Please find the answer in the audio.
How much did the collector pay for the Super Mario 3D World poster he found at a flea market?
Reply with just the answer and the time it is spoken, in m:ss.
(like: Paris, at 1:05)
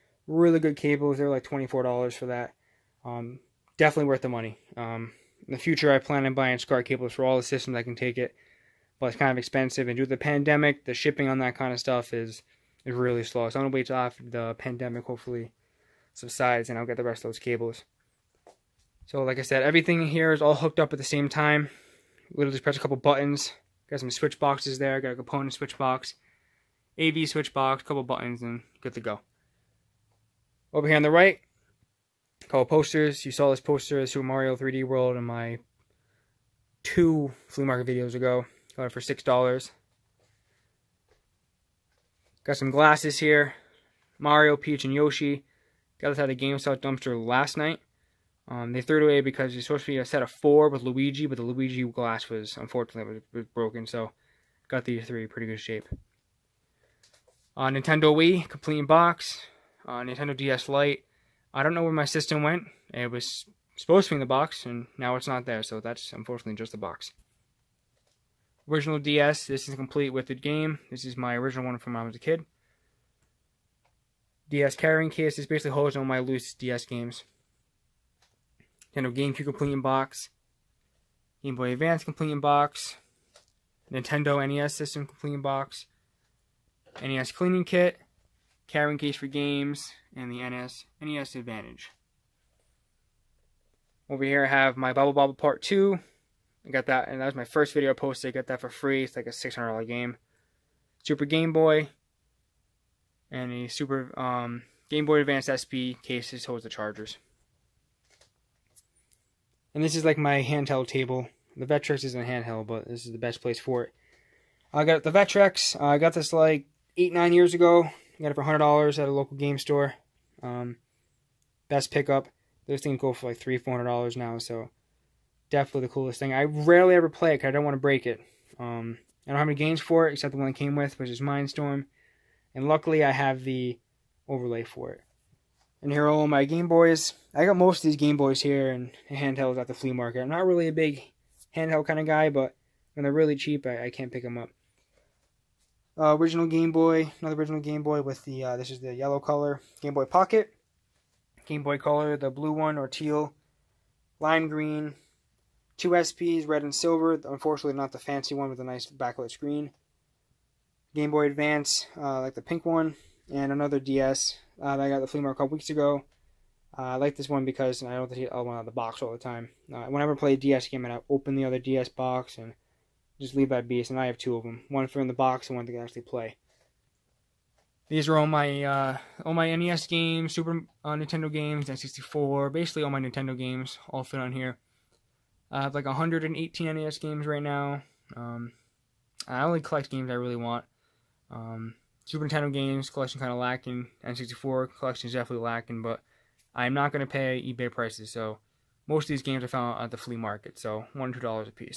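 $6, at 0:39.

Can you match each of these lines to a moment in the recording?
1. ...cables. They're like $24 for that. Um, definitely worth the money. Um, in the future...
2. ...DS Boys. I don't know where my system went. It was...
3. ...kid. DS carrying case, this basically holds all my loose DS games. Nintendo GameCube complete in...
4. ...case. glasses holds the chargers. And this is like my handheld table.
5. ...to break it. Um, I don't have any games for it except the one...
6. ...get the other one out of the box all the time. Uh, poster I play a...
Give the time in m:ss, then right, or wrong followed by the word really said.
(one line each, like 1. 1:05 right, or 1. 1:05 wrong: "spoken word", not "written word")
1. 0:00 right
2. 1:00 wrong: "Lite", not "Boys"
3. 1:12 right
4. 1:46 wrong: "cases", not "glasses"
5. 2:07 right
6. 2:48 wrong: "whenever", not "poster".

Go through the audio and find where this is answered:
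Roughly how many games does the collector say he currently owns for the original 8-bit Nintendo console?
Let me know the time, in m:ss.
3:05.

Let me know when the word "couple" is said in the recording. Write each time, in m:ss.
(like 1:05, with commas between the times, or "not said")
0:22, 0:27, 2:45.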